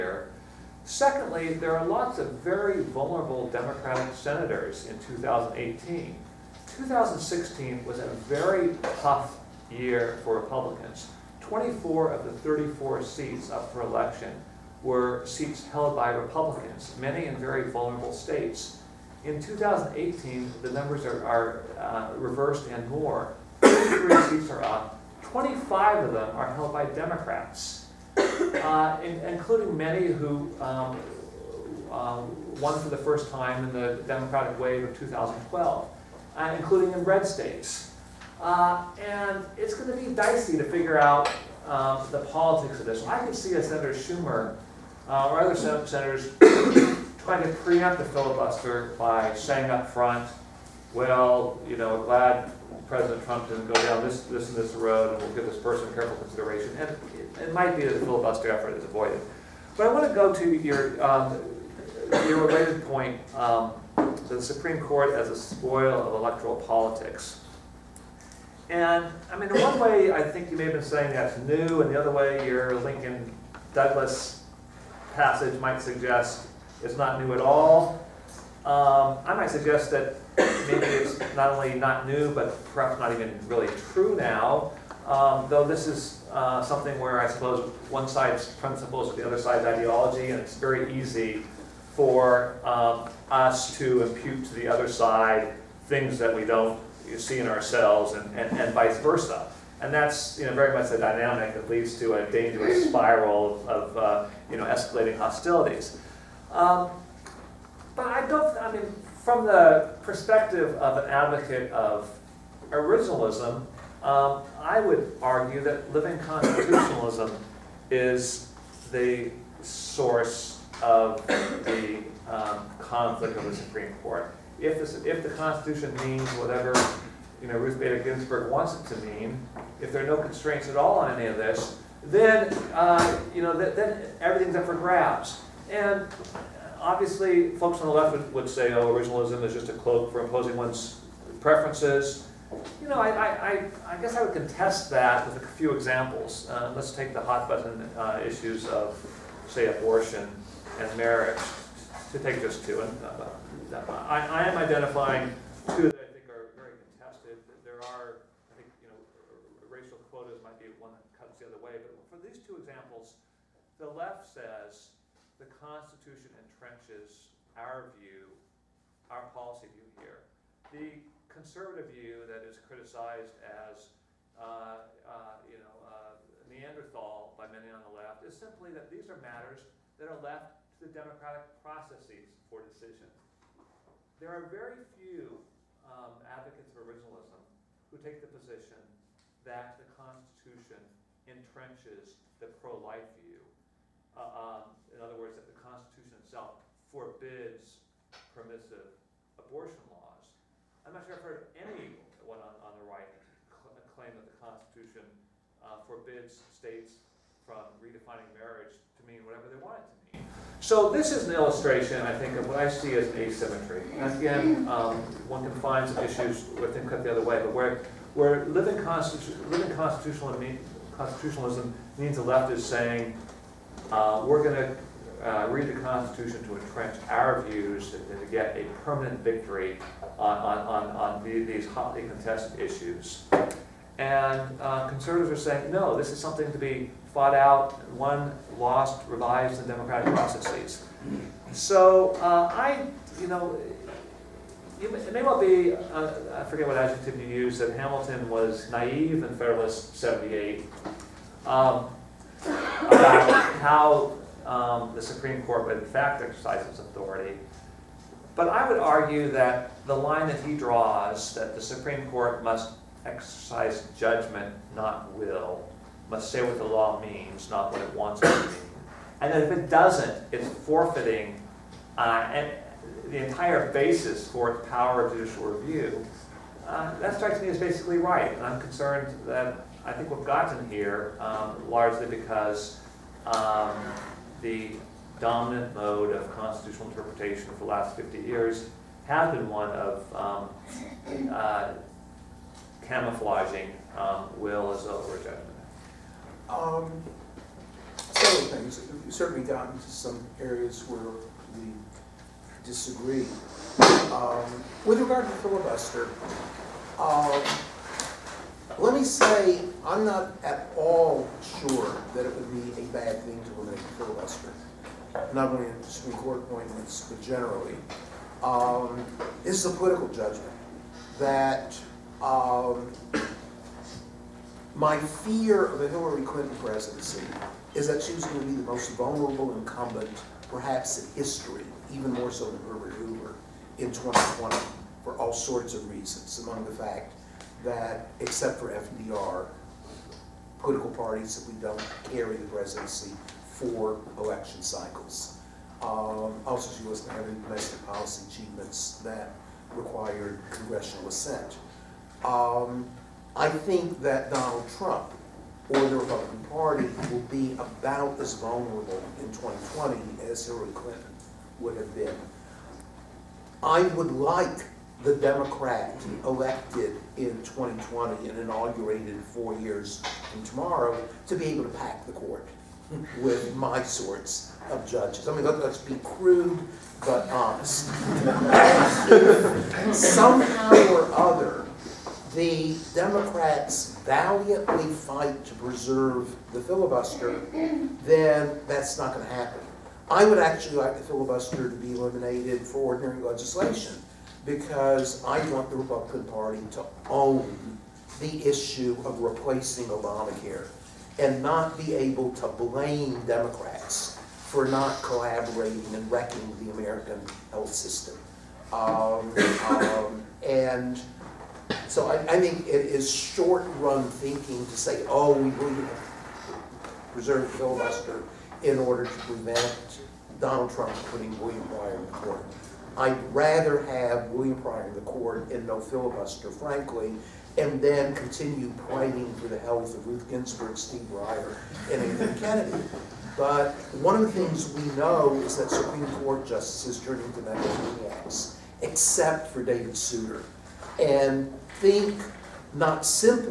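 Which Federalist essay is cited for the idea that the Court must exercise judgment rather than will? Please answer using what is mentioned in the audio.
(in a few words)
Federalist 78.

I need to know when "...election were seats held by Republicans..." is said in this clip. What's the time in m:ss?
0:13.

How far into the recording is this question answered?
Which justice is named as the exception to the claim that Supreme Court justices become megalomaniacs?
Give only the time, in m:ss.
7:19.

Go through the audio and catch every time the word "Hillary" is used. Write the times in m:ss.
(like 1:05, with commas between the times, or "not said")
5:25, 6:00.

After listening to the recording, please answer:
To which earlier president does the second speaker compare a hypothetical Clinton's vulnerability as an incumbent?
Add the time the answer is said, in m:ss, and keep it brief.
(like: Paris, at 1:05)
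Herbert Hoover, at 5:32.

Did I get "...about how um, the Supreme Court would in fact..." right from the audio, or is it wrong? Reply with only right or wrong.
right.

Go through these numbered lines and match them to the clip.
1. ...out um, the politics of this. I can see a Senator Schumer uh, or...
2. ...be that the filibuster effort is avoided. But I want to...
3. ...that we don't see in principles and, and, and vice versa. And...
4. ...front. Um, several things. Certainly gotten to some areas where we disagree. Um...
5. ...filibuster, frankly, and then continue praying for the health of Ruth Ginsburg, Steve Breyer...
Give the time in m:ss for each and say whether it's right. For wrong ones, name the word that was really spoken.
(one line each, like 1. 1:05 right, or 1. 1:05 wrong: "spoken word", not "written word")
1. 0:40 right
2. 0:57 right
3. 1:36 wrong: "ourselves", not "principles"
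4. 4:55 wrong: "judgment", not "front"
5. 7:05 right.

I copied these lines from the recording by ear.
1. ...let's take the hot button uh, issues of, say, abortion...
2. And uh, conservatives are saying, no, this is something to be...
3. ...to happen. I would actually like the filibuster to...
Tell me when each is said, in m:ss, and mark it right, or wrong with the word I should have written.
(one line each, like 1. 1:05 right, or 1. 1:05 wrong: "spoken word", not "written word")
1. 2:26 right
2. 3:53 right
3. 6:29 right.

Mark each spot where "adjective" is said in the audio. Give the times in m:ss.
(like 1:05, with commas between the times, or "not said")
4:06.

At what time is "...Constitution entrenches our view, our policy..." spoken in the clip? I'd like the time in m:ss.
2:45.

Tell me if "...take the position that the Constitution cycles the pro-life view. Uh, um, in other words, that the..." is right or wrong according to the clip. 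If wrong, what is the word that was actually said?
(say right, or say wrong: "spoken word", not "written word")
wrong: "entrenches", not "cycles".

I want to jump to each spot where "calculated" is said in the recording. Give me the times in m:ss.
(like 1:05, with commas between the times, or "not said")
not said.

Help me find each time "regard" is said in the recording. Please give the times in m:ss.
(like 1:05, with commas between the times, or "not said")
5:04.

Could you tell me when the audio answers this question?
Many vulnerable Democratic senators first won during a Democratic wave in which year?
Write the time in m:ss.
0:34.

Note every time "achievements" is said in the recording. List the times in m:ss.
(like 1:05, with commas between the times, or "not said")
5:48.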